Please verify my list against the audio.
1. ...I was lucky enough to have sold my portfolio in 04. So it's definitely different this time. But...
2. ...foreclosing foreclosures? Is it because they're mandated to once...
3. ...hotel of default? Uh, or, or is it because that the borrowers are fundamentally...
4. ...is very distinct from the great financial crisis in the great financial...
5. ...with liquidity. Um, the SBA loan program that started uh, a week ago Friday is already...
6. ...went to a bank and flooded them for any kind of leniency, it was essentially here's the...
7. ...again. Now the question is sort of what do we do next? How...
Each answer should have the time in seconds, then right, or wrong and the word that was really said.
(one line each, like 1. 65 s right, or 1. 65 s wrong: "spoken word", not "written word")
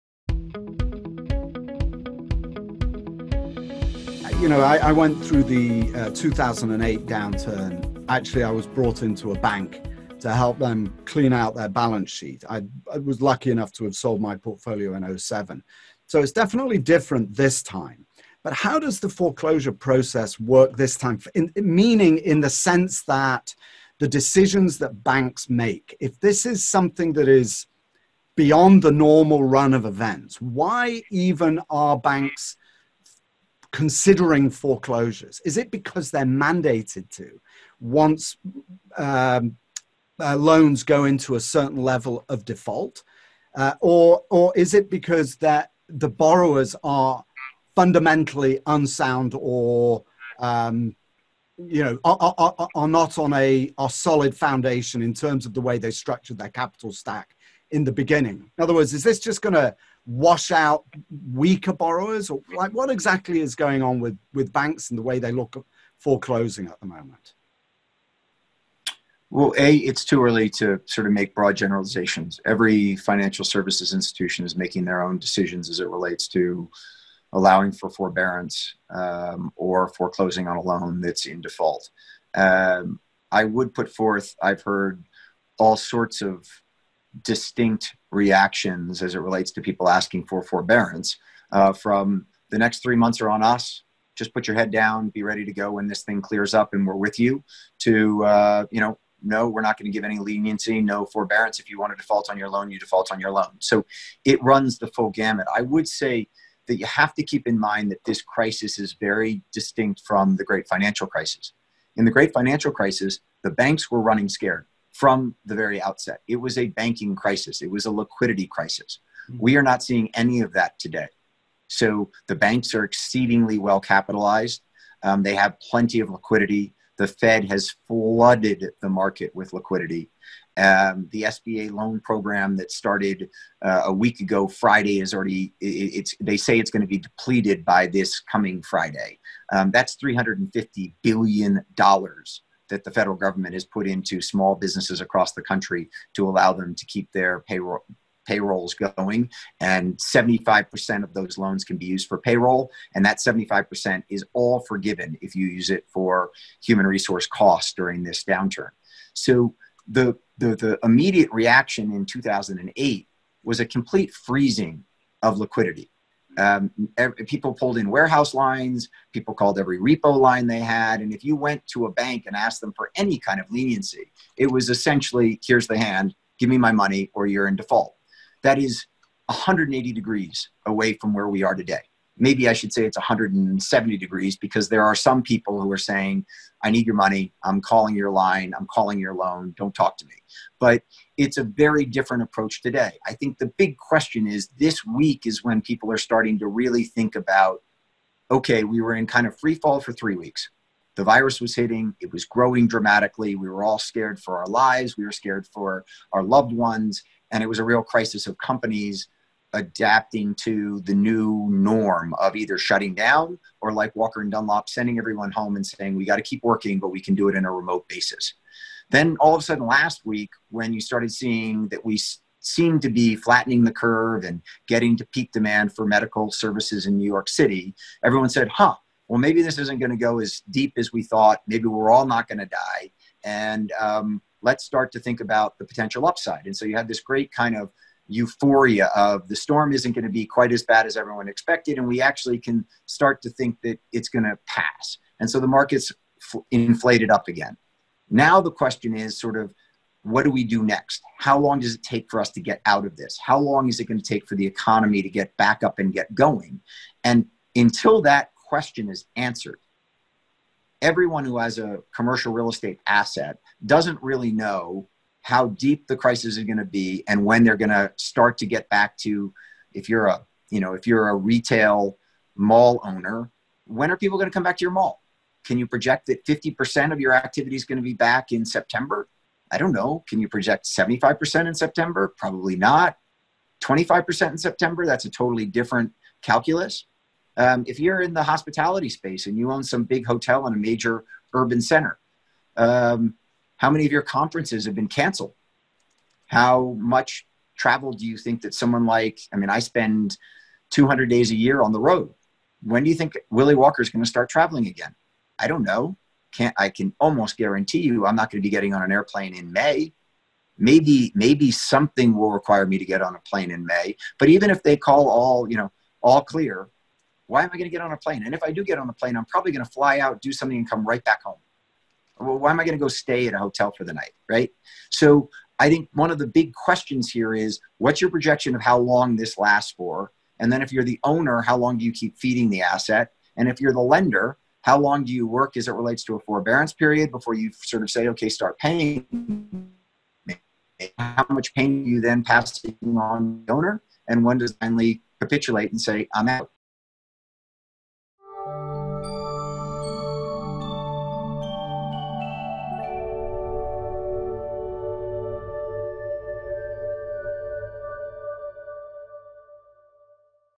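1. 12 s wrong: "07", not "04"
2. 33 s wrong: "considering", not "foreclosing"
3. 41 s wrong: "level", not "hotel"
4. 108 s right
5. 129 s right
6. 171 s wrong: "asked", not "flooded"
7. 247 s right.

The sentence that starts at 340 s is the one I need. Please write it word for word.
How much pain you then passing on the owner?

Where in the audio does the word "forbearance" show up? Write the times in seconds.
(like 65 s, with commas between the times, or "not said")
77 s, 90 s, 101 s, 336 s.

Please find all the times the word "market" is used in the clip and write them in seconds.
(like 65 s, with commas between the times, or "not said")
128 s, 245 s.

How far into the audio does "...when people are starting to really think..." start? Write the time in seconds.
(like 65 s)
195 s.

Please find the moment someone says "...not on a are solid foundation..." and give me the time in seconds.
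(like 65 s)
52 s.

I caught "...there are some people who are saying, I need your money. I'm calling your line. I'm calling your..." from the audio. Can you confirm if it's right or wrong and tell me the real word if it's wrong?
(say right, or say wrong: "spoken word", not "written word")
right.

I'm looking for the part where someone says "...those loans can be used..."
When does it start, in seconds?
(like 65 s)
151 s.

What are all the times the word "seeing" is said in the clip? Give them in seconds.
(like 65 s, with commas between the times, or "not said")
119 s, 221 s.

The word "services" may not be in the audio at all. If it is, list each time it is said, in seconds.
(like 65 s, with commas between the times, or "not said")
73 s, 226 s.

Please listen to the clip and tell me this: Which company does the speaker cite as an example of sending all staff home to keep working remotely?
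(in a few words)
Walker and Dunlop.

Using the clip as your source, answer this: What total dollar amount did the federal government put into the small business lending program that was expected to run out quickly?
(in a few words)
$350 billion.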